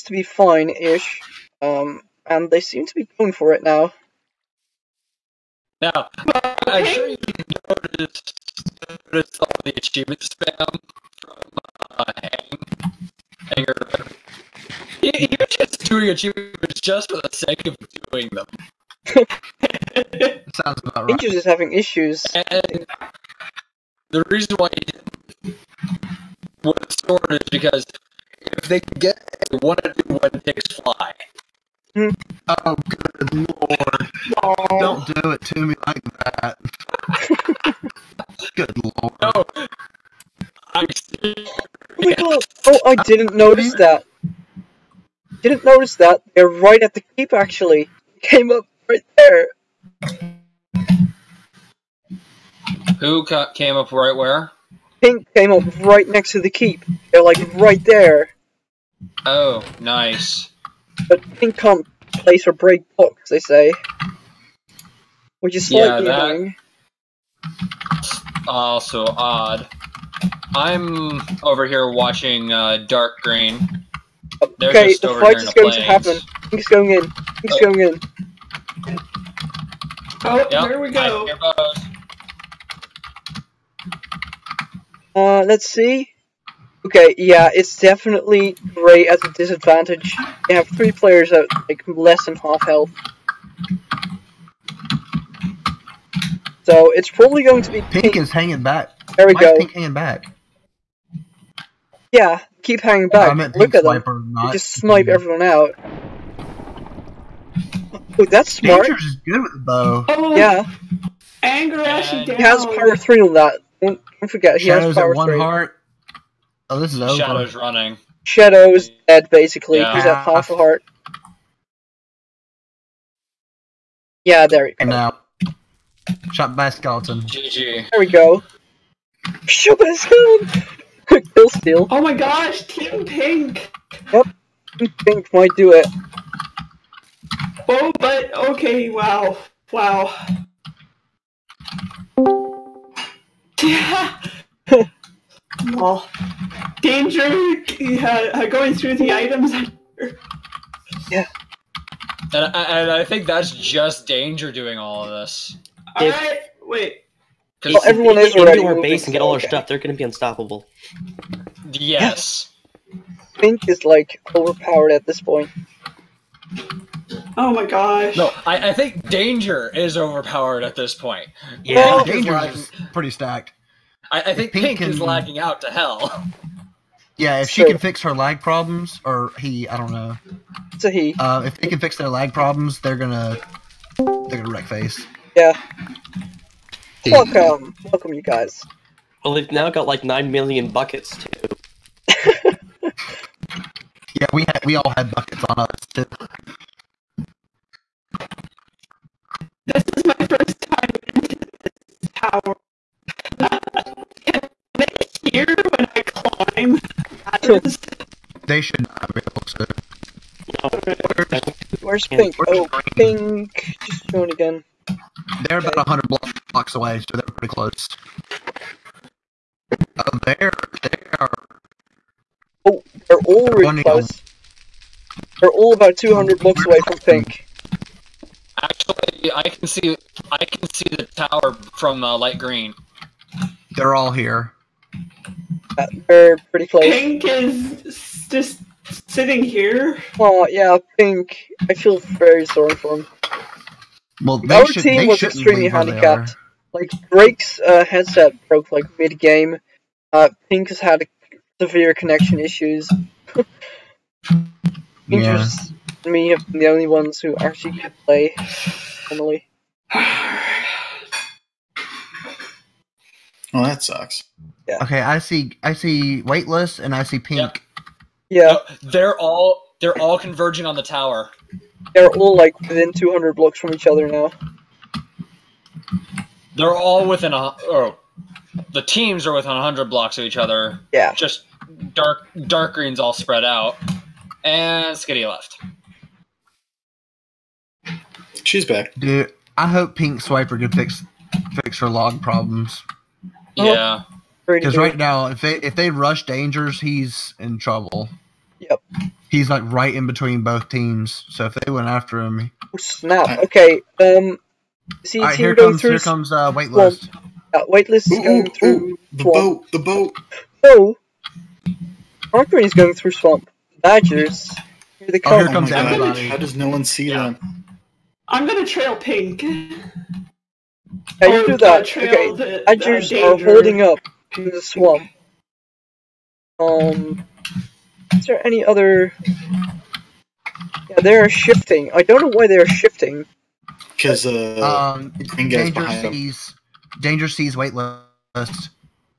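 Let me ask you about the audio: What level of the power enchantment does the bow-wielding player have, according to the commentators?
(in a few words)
3.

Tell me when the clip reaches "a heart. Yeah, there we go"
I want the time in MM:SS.
02:00.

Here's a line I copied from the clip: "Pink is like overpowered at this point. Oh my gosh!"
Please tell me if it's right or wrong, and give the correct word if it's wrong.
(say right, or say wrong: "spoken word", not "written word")
right.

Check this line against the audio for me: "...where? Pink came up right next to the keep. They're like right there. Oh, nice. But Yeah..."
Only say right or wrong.
wrong.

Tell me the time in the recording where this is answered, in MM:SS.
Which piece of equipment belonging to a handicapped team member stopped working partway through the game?
04:07.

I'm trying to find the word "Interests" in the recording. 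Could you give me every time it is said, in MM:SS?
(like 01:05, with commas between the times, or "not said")
04:15.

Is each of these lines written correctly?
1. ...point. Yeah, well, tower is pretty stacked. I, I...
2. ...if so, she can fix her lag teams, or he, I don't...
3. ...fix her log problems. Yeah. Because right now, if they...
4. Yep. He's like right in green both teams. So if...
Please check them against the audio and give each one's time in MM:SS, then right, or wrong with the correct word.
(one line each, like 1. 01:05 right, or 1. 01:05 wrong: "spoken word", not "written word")
1. 02:50 wrong: "danger", not "tower"
2. 02:57 wrong: "problems", not "teams"
3. 04:51 right
4. 04:58 wrong: "between", not "green".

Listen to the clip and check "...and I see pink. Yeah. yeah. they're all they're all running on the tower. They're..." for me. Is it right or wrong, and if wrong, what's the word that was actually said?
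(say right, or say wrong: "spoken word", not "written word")
wrong: "converging", not "running".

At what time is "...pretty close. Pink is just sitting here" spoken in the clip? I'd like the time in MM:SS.
03:56.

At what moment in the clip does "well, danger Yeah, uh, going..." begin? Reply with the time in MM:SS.
02:25.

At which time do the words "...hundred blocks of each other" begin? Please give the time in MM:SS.
04:39.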